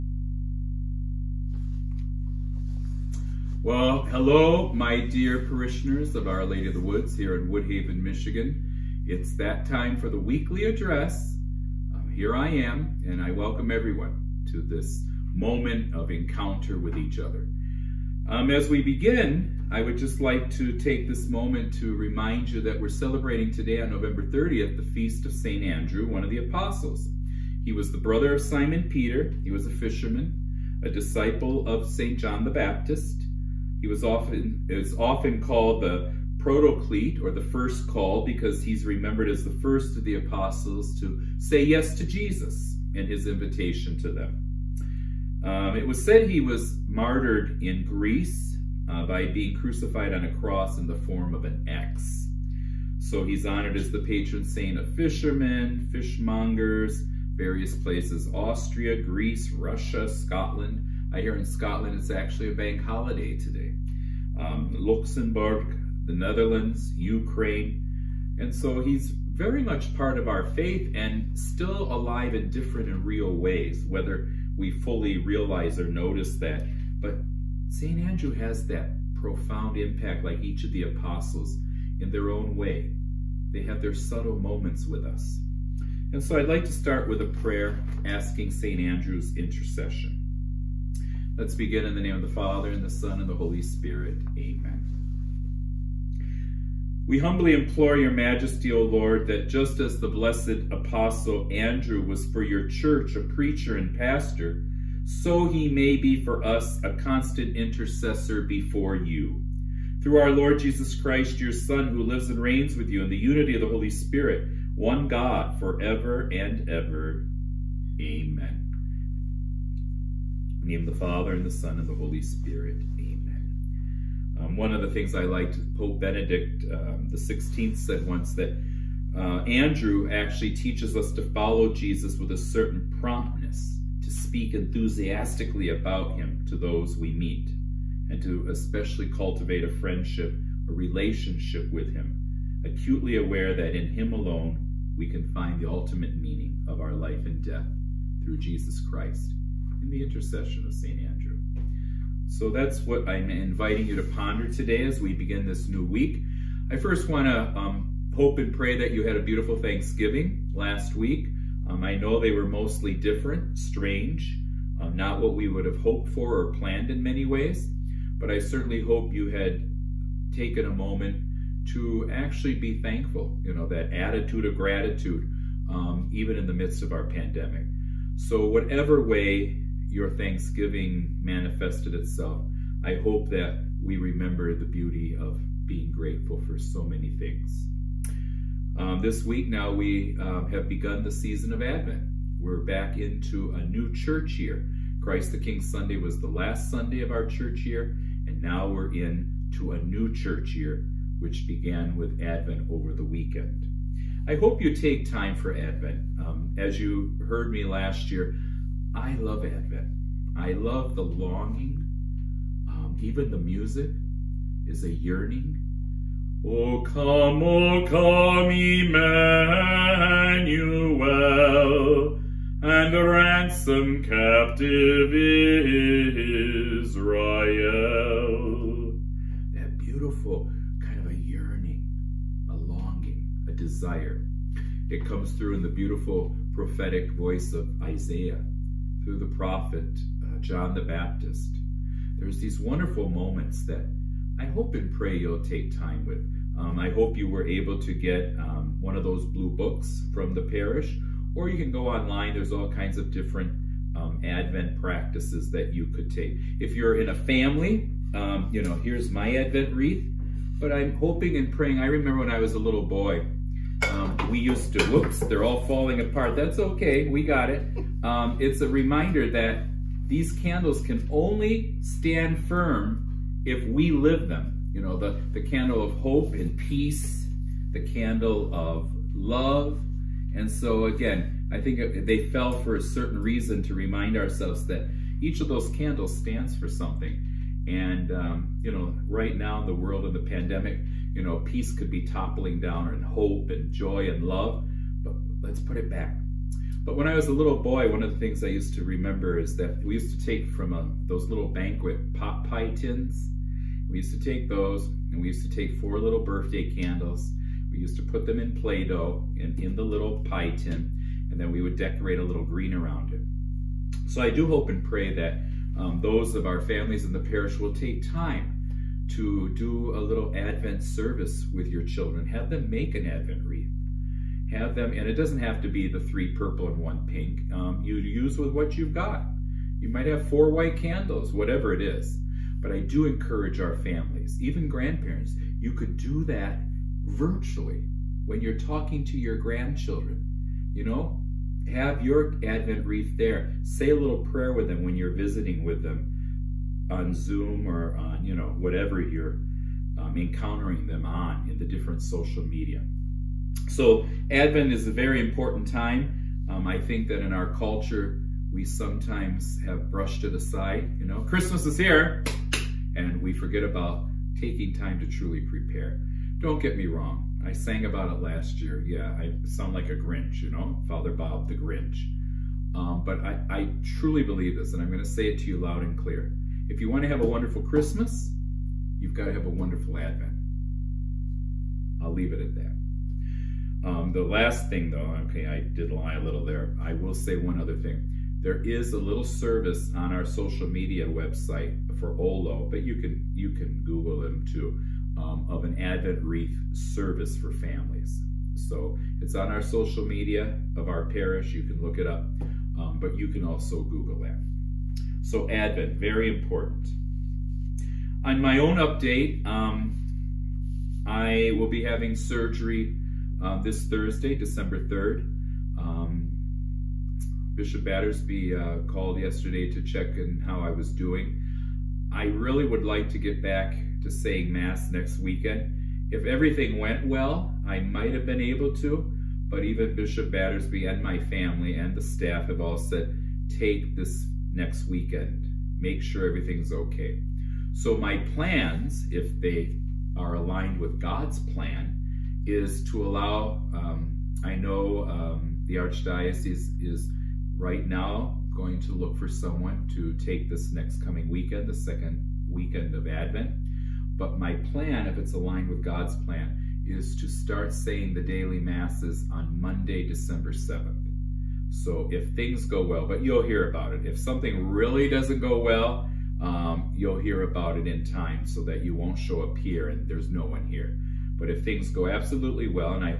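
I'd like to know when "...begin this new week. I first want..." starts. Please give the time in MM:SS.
02:35.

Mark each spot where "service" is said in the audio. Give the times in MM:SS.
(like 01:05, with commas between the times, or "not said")
05:20, 06:29, 06:36.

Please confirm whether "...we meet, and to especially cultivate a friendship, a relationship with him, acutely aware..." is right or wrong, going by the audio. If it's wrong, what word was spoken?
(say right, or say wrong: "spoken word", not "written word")
right.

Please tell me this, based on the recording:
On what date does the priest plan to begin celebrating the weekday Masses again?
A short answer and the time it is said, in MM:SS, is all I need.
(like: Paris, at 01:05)
Monday, December 7, at 07:39.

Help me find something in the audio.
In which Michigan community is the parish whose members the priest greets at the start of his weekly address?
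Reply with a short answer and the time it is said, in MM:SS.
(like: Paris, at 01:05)
Woodhaven, at 00:07.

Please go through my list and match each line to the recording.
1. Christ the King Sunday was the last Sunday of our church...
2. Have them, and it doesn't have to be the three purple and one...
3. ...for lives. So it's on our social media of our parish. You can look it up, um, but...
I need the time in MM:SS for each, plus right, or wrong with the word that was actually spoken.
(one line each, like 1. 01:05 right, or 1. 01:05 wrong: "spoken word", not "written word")
1. 03:14 right
2. 05:24 right
3. 06:37 wrong: "families", not "lives".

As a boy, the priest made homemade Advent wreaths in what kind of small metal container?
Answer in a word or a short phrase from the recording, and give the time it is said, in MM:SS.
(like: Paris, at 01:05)
banquet pot pie tins, at 05:01.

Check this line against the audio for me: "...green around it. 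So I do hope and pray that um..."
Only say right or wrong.
right.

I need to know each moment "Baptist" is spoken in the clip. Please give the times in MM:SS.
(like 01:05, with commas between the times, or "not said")
00:32, 04:00.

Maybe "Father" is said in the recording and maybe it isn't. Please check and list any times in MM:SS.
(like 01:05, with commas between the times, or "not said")
01:32, 02:00, 06:10.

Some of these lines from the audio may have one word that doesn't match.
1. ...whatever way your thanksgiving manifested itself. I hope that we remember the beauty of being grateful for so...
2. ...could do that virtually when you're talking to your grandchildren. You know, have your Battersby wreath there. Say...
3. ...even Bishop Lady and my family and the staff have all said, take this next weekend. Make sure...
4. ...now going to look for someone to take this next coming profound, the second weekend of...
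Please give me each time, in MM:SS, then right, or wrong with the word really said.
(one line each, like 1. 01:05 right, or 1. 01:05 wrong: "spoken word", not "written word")
1. 02:58 right
2. 05:35 wrong: "Advent", not "Battersby"
3. 07:09 wrong: "Battersby", not "Lady"
4. 07:27 wrong: "weekend", not "profound".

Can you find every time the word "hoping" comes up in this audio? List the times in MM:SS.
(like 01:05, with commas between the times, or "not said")
04:20.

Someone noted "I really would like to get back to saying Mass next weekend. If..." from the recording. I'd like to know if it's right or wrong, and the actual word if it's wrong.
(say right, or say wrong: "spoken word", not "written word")
right.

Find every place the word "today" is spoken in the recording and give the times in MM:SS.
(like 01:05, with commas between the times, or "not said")
00:23, 01:03, 02:34.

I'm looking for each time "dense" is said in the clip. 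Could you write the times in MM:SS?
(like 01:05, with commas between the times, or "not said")
not said.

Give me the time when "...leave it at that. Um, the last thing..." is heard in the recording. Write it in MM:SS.
06:22.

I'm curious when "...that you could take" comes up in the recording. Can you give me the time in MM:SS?
04:15.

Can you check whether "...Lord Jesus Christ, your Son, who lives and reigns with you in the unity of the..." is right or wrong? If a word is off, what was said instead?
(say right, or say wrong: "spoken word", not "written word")
right.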